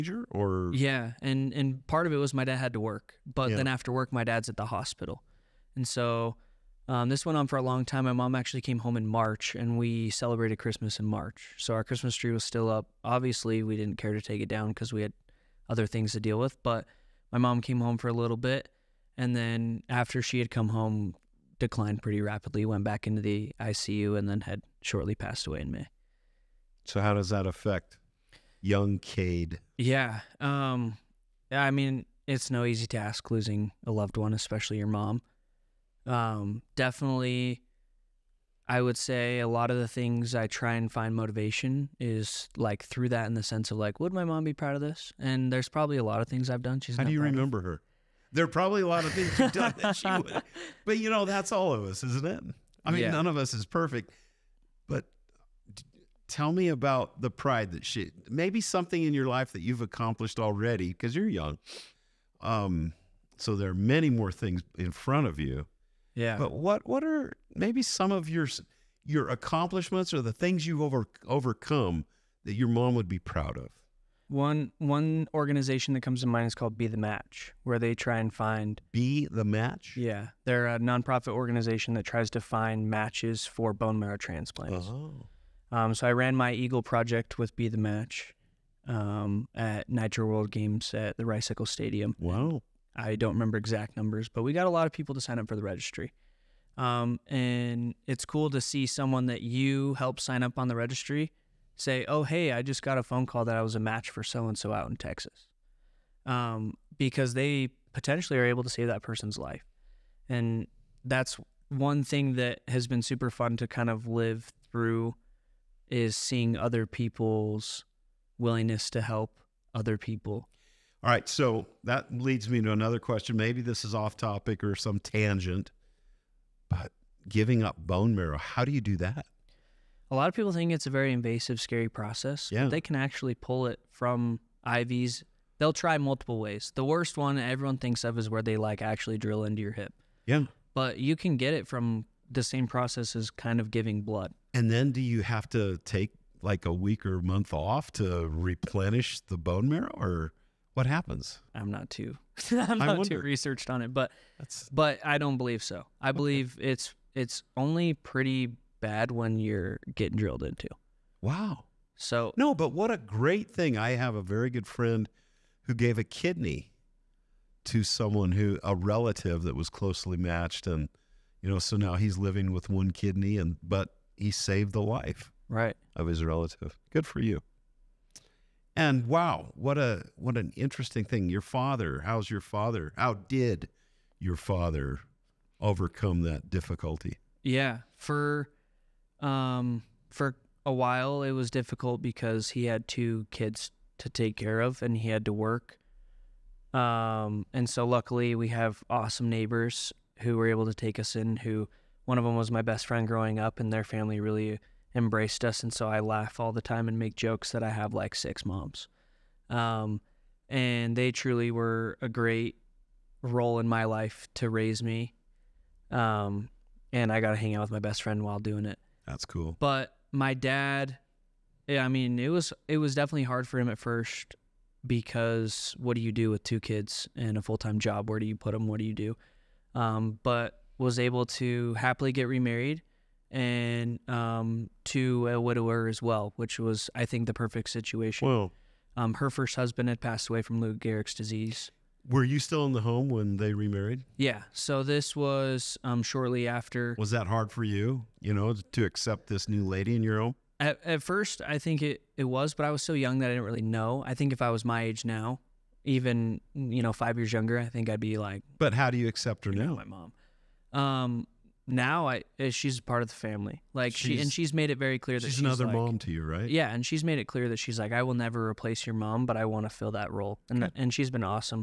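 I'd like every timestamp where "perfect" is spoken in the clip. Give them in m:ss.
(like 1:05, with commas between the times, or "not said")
0:53, 3:57.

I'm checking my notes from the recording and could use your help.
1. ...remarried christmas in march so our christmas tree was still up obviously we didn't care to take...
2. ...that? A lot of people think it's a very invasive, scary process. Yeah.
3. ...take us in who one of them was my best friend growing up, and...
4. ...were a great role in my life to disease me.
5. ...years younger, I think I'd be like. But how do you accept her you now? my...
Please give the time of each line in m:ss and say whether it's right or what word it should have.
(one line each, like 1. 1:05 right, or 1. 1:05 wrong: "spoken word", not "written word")
1. 0:10 wrong: "celebrated", not "remarried"
2. 2:08 right
3. 3:20 right
4. 3:31 wrong: "raise", not "disease"
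5. 4:17 right.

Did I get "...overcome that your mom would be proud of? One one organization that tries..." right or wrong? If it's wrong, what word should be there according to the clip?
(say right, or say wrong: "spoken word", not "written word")
wrong: "comes", not "tries".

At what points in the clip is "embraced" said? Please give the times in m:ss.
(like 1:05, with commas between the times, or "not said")
3:24.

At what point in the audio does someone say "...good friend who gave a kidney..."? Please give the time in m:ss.
2:44.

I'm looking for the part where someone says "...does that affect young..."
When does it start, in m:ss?
0:27.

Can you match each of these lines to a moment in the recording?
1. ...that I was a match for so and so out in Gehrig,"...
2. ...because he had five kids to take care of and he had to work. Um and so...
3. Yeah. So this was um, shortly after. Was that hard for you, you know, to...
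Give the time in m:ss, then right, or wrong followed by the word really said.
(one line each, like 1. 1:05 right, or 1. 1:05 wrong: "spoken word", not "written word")
1. 1:43 wrong: "Texas", not "Gehrig"
2. 3:12 wrong: "two", not "five"
3. 4:04 right.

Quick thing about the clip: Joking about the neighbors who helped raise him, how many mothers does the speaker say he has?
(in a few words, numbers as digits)
6.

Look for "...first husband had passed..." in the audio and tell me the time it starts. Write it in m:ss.
3:59.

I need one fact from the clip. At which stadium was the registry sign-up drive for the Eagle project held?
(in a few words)
Rice-Eccles Stadium.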